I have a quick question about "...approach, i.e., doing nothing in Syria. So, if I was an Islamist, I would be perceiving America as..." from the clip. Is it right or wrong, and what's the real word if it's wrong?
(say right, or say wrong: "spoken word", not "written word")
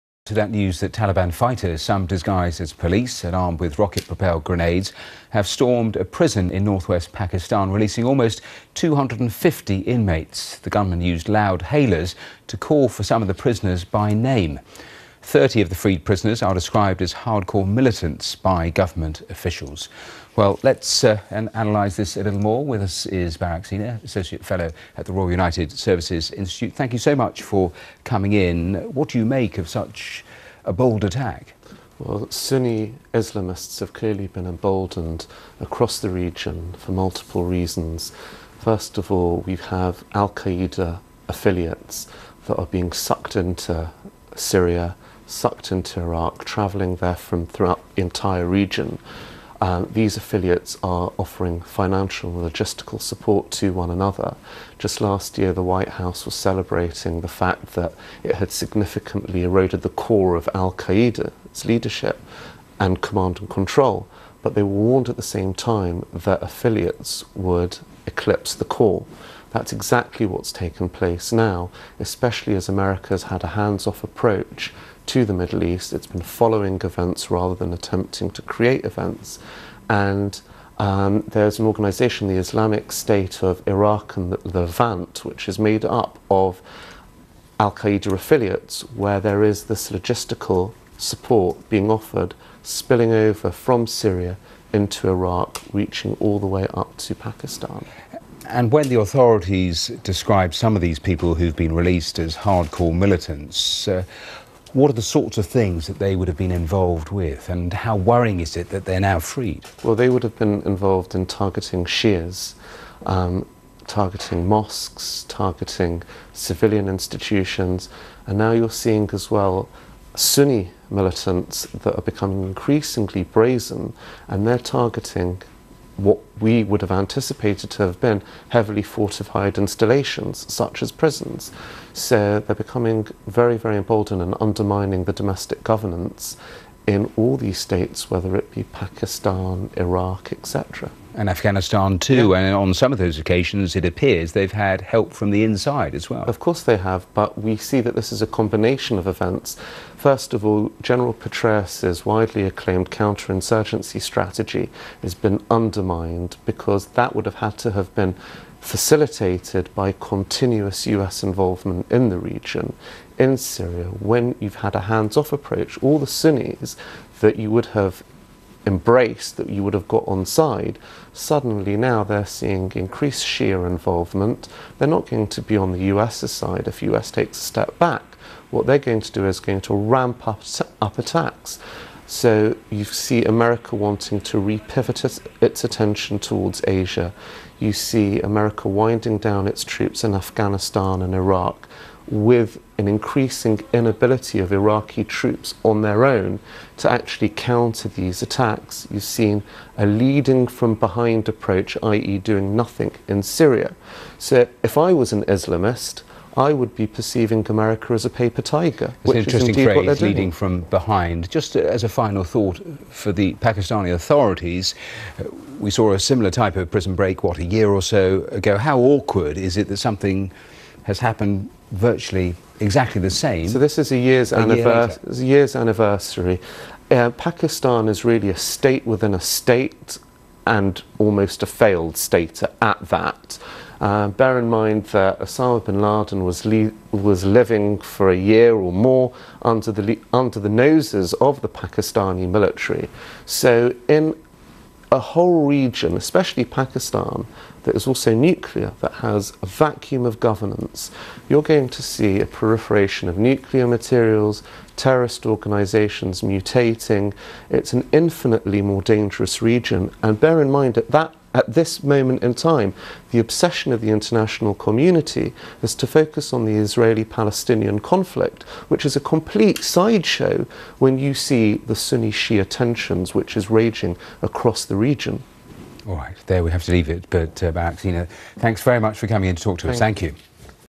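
right.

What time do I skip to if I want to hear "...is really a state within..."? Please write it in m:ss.
3:47.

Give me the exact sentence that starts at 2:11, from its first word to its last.
So they're becoming very, very emboldened and undermining the domestic governance in all these states, whether it be Pakistan, Iraq, etc.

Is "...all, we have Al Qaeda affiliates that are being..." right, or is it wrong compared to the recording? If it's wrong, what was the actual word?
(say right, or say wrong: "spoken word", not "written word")
right.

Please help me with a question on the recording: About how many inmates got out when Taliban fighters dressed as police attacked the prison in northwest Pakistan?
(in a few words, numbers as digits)
almost 250.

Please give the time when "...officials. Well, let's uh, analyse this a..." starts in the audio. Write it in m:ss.
0:19.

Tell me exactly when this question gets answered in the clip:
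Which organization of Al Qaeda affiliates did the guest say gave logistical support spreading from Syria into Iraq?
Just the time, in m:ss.
1:22.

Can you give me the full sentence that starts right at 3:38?
How awkward is it that something has happened virtually exactly the same.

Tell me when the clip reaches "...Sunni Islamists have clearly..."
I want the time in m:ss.
0:32.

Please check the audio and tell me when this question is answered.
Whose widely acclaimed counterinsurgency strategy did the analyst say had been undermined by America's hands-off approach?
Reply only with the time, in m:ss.
2:30.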